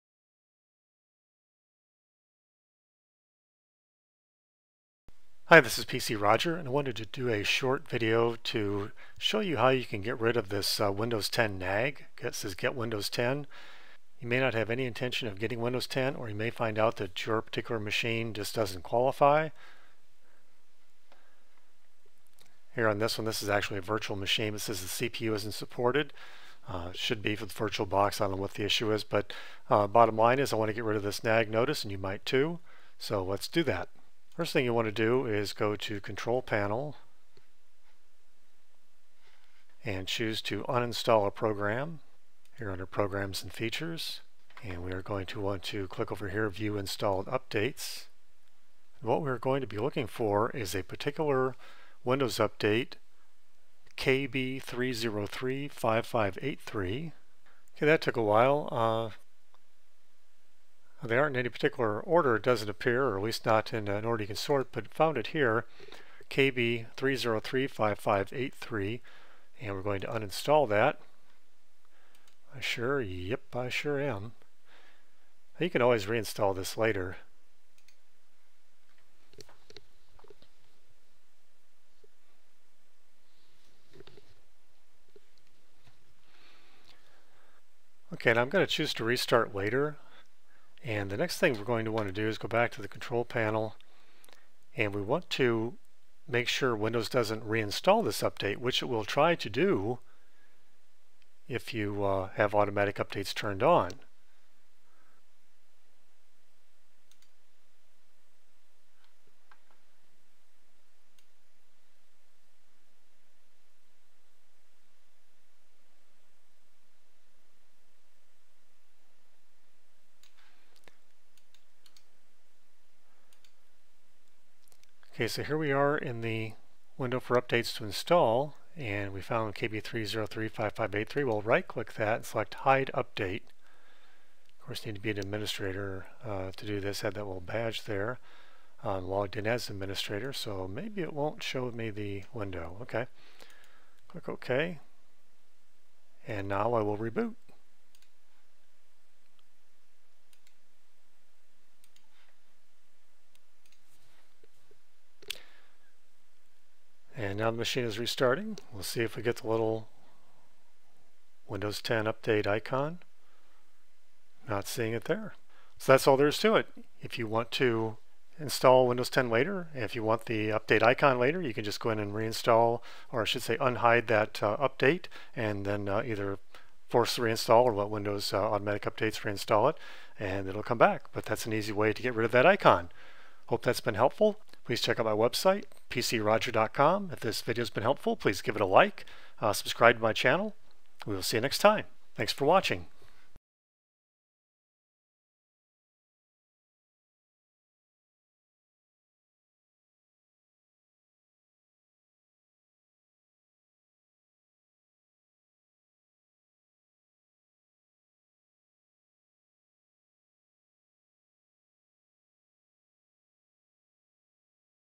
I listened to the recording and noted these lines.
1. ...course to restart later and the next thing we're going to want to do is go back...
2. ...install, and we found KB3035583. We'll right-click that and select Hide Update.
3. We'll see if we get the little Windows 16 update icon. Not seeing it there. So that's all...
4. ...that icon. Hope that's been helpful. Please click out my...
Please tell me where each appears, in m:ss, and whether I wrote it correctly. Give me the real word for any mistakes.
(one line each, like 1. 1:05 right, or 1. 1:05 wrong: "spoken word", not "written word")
1. 1:28 wrong: "choose", not "course"
2. 2:07 right
3. 2:38 wrong: "10", not "16"
4. 3:02 wrong: "check", not "click".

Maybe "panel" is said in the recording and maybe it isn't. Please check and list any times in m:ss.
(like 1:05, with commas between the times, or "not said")
0:36, 1:33.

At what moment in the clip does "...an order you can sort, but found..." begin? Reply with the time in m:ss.
1:03.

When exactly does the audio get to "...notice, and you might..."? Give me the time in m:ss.
0:31.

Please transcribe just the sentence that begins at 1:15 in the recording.
You can always reinstall this later.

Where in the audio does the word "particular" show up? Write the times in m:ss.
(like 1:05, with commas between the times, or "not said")
0:17, 0:50, 1:01.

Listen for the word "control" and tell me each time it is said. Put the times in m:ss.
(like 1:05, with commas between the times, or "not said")
0:35, 1:32.